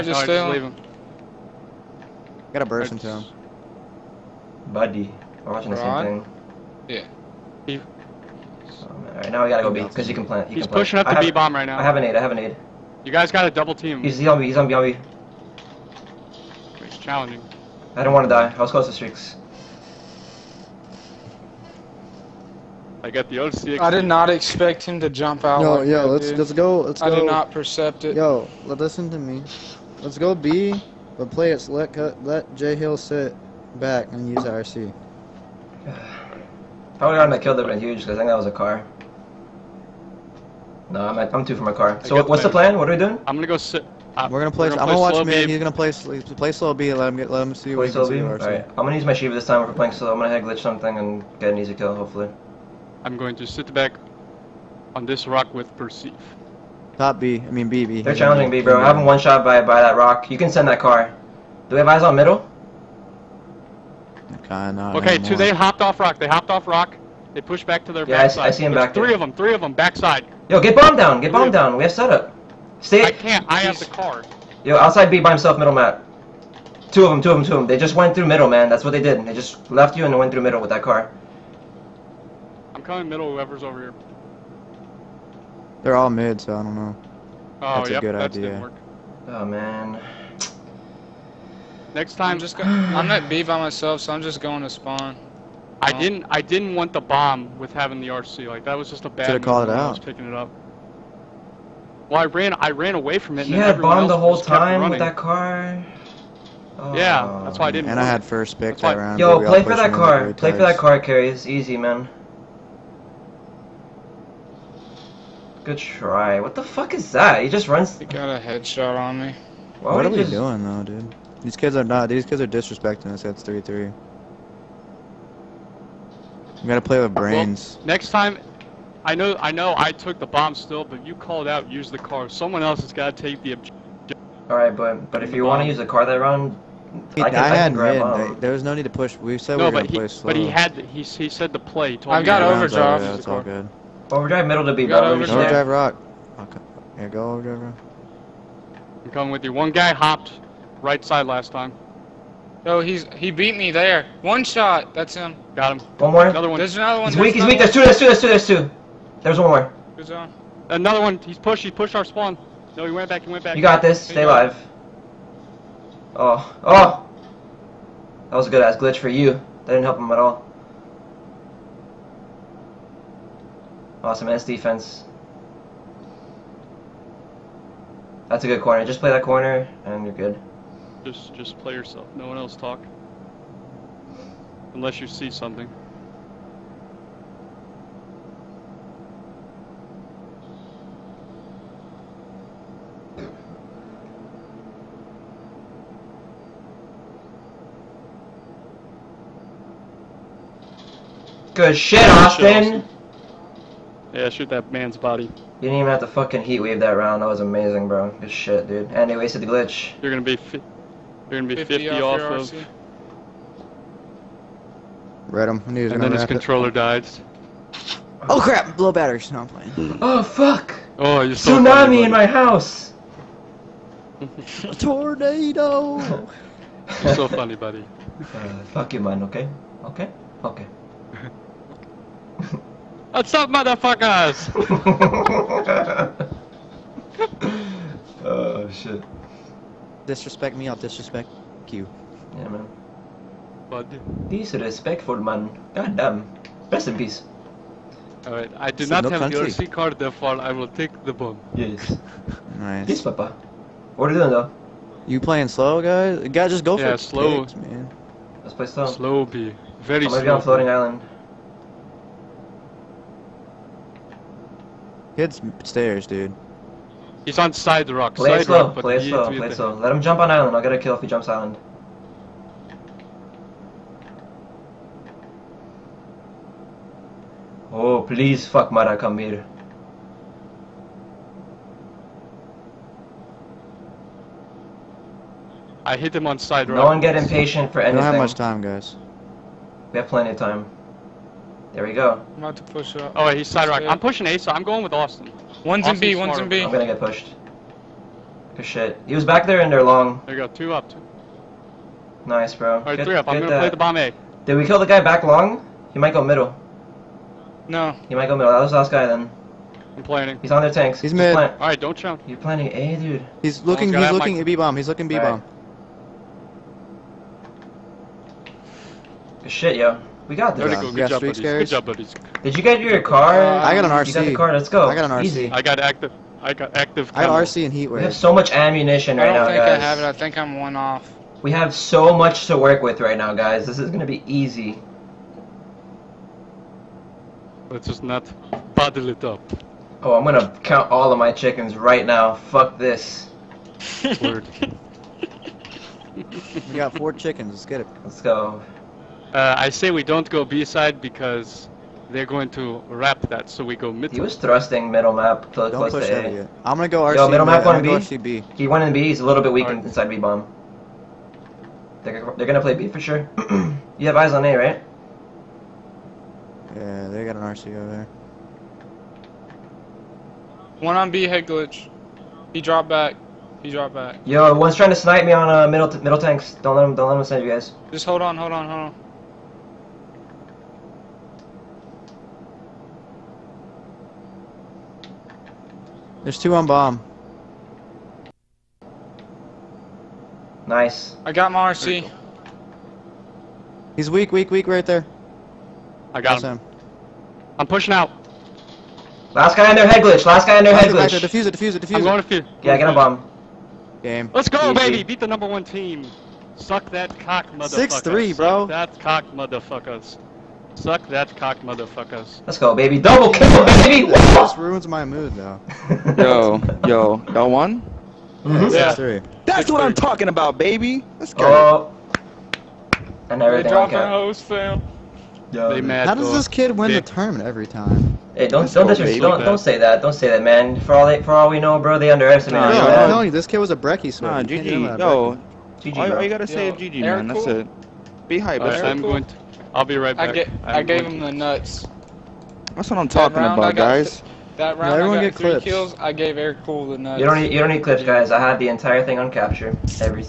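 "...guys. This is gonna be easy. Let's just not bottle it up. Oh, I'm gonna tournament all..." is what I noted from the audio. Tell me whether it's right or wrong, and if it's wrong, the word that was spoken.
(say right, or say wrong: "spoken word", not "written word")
wrong: "count", not "tournament".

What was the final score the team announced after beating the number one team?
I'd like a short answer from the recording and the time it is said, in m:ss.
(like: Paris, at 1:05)
6-3, at 6:48.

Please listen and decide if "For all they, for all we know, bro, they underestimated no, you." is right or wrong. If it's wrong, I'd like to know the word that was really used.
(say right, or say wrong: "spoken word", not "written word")
right.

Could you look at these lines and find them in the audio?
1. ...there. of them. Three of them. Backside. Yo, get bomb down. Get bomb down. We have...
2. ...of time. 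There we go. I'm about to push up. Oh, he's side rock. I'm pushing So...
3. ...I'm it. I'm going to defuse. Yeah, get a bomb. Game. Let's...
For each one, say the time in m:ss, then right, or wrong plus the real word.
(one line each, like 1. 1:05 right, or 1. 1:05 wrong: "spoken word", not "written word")
1. 1:09 right
2. 4:50 right
3. 6:41 right.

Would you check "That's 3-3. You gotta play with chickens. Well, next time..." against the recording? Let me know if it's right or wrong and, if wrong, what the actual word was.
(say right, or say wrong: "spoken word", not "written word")
wrong: "brains", not "chickens".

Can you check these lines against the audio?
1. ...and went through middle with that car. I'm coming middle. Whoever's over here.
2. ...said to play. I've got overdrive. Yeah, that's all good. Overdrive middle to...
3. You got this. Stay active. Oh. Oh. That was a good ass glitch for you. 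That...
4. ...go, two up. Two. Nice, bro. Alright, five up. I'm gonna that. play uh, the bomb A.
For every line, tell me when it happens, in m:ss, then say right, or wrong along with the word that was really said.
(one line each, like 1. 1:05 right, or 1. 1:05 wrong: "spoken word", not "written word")
1. 1:20 right
2. 2:21 right
3. 2:43 wrong: "alive", not "active"
4. 5:00 wrong: "three", not "five".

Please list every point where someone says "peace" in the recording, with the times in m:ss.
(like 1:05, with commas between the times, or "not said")
4:06, 4:12.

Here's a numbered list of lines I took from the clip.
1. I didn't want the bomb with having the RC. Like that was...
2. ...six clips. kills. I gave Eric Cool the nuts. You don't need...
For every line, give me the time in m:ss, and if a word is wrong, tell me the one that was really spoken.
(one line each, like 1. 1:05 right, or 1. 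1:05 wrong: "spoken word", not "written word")
1. 1:36 right
2. 7:25 wrong: "three", not "six".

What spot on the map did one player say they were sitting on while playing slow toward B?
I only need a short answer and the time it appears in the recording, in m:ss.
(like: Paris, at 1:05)
Floating island, at 4:20.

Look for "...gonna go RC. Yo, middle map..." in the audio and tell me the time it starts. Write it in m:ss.
5:56.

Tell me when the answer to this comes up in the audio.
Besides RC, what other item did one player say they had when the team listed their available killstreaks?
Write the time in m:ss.
5:27.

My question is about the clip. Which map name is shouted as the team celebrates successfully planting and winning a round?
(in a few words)
Vertigo.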